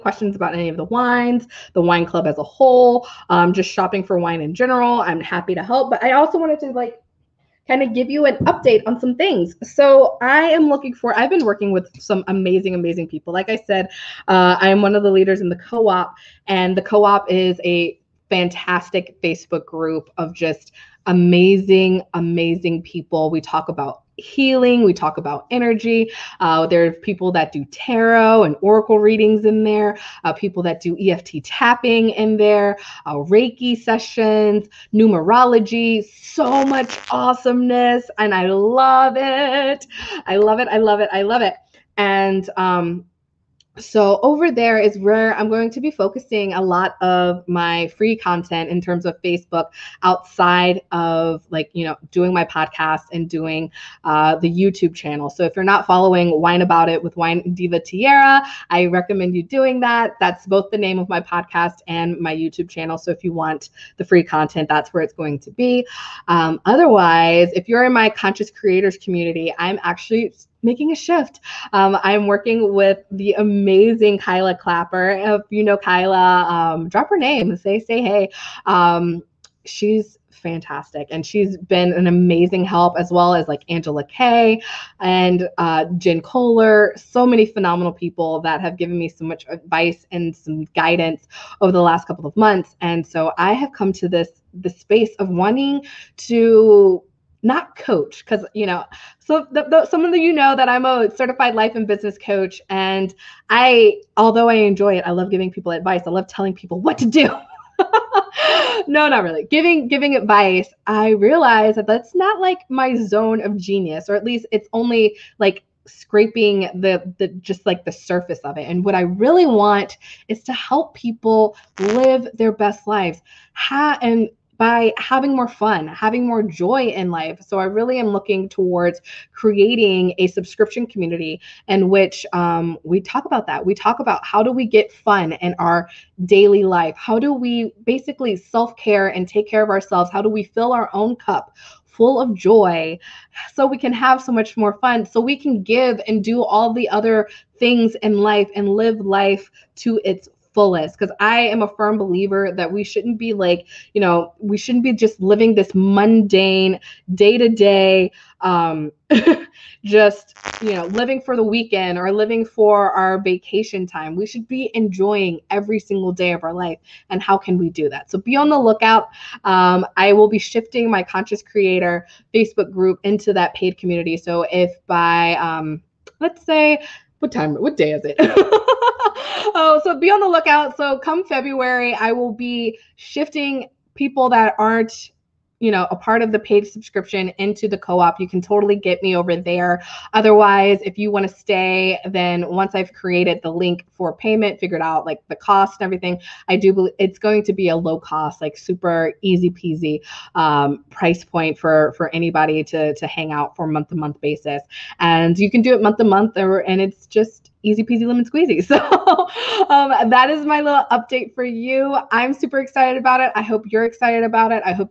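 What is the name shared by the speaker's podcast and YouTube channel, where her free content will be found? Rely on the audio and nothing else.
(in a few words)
Wine About It.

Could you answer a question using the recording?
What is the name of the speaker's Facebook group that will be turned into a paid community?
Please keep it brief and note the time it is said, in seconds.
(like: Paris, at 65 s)
Conscious Creator, at 171 s.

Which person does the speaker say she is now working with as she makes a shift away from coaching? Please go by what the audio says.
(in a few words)
Kyla Clapper.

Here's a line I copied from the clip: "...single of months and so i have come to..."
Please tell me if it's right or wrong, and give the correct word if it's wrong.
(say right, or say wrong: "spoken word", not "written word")
wrong: "couple", not "single".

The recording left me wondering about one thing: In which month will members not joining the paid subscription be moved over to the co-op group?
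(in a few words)
February.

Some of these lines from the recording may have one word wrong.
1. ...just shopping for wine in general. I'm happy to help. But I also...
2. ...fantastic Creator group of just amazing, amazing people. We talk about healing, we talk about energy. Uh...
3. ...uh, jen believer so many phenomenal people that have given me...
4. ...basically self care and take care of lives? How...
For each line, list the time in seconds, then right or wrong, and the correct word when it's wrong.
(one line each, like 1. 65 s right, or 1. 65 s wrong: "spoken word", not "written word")
1. 3 s right
2. 18 s wrong: "Facebook", not "Creator"
3. 85 s wrong: "kohler", not "believer"
4. 137 s wrong: "ourselves", not "lives".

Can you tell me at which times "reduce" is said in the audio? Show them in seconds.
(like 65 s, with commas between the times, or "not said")
not said.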